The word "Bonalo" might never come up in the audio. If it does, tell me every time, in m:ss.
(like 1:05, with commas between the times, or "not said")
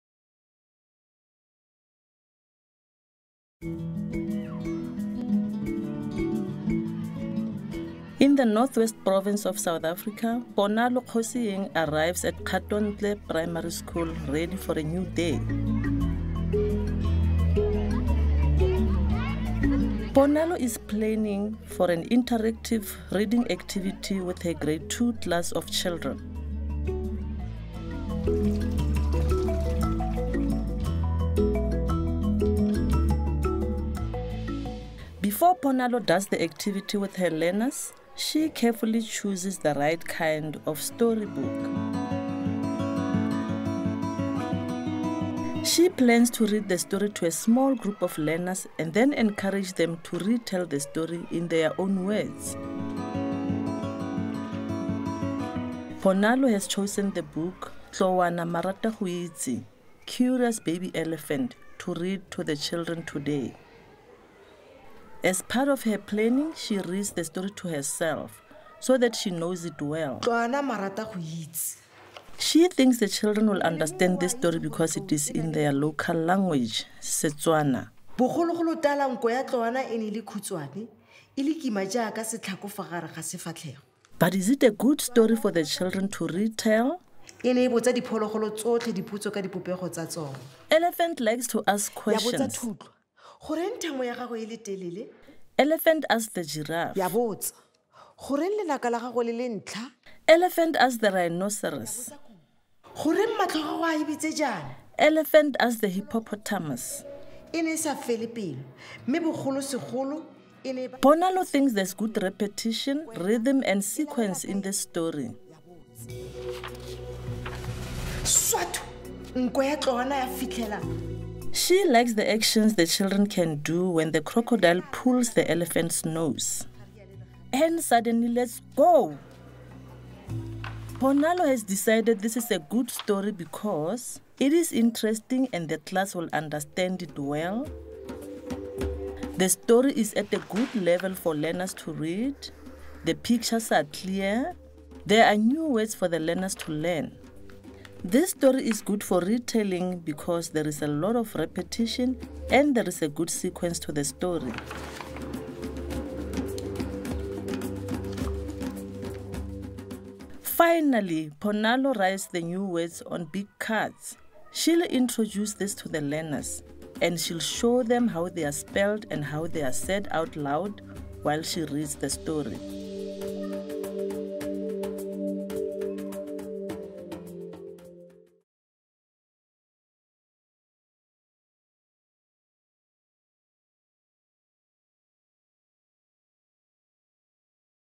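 0:10, 0:20, 0:35, 0:56, 1:51, 2:11, 2:41.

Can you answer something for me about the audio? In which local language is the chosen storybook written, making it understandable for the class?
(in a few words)
Setswana.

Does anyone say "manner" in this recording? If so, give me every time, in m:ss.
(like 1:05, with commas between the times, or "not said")
not said.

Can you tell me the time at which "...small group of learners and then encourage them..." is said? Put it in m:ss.
0:47.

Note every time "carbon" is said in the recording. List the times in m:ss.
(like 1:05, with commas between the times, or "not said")
not said.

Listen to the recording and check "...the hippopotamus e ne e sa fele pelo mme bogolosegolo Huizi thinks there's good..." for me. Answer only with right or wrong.
wrong.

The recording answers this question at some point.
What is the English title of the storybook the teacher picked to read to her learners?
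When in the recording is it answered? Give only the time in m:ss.
1:00.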